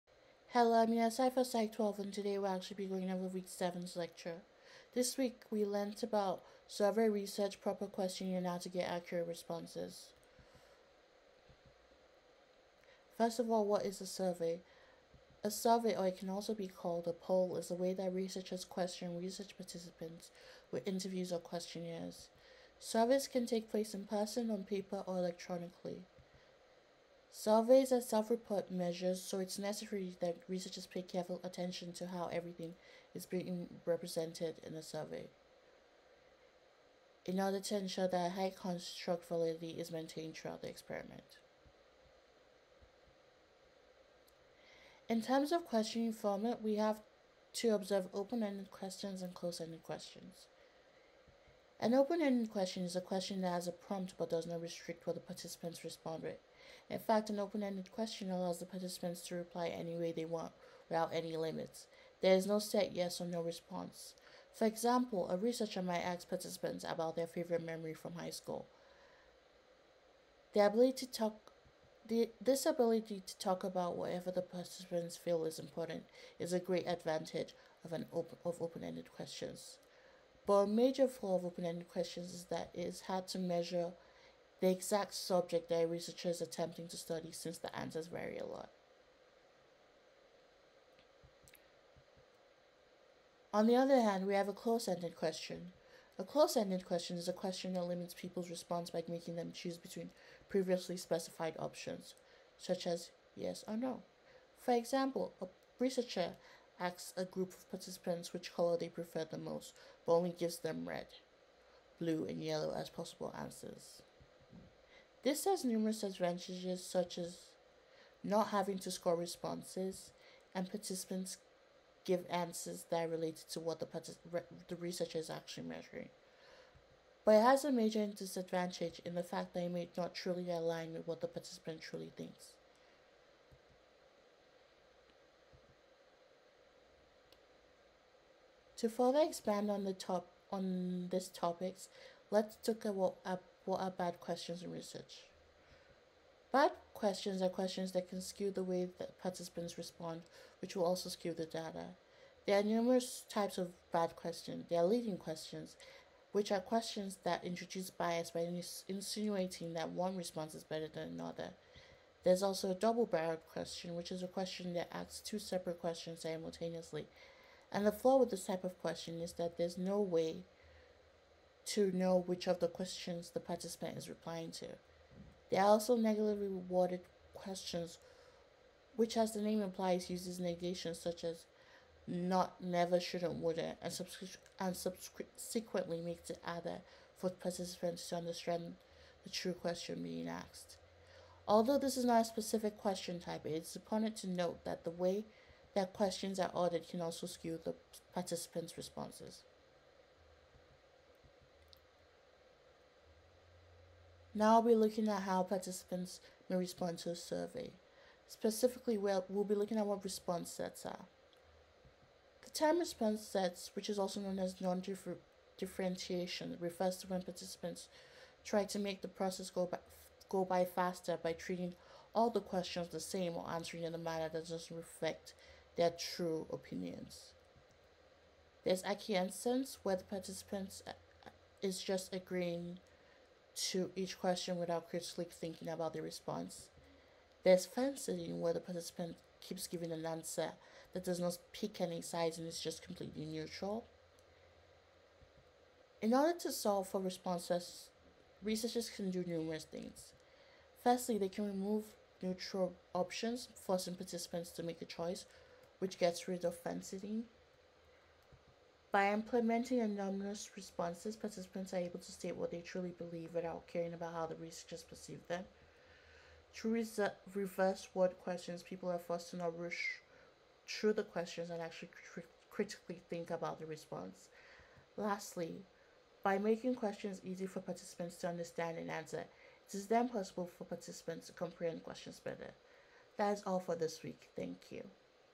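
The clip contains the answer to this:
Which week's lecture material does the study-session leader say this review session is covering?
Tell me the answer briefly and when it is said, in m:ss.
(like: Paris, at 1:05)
Week 7, at 0:03.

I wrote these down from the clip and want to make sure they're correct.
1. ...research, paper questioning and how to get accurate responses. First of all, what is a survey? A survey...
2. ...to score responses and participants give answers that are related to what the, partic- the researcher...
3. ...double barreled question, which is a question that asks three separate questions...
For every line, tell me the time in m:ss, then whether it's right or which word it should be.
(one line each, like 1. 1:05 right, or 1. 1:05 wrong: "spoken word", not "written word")
1. 0:07 wrong: "proper", not "paper"
2. 1:58 right
3. 2:42 wrong: "two", not "three".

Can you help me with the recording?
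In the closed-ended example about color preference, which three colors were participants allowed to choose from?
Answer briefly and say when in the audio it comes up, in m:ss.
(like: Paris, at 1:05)
red, blue, and yellow, at 1:50.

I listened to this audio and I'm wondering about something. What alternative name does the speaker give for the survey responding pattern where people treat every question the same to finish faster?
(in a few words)
non-differentiation.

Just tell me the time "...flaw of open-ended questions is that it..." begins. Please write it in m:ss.
1:21.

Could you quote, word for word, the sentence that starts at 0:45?
In terms of questioning format, we have to observe open-ended questions and closed-ended questions.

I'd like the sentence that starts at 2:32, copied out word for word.
There are numerous types of bad questions.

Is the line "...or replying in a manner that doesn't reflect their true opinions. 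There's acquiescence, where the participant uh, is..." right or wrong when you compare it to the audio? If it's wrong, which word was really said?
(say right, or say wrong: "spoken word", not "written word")
wrong: "answering", not "replying".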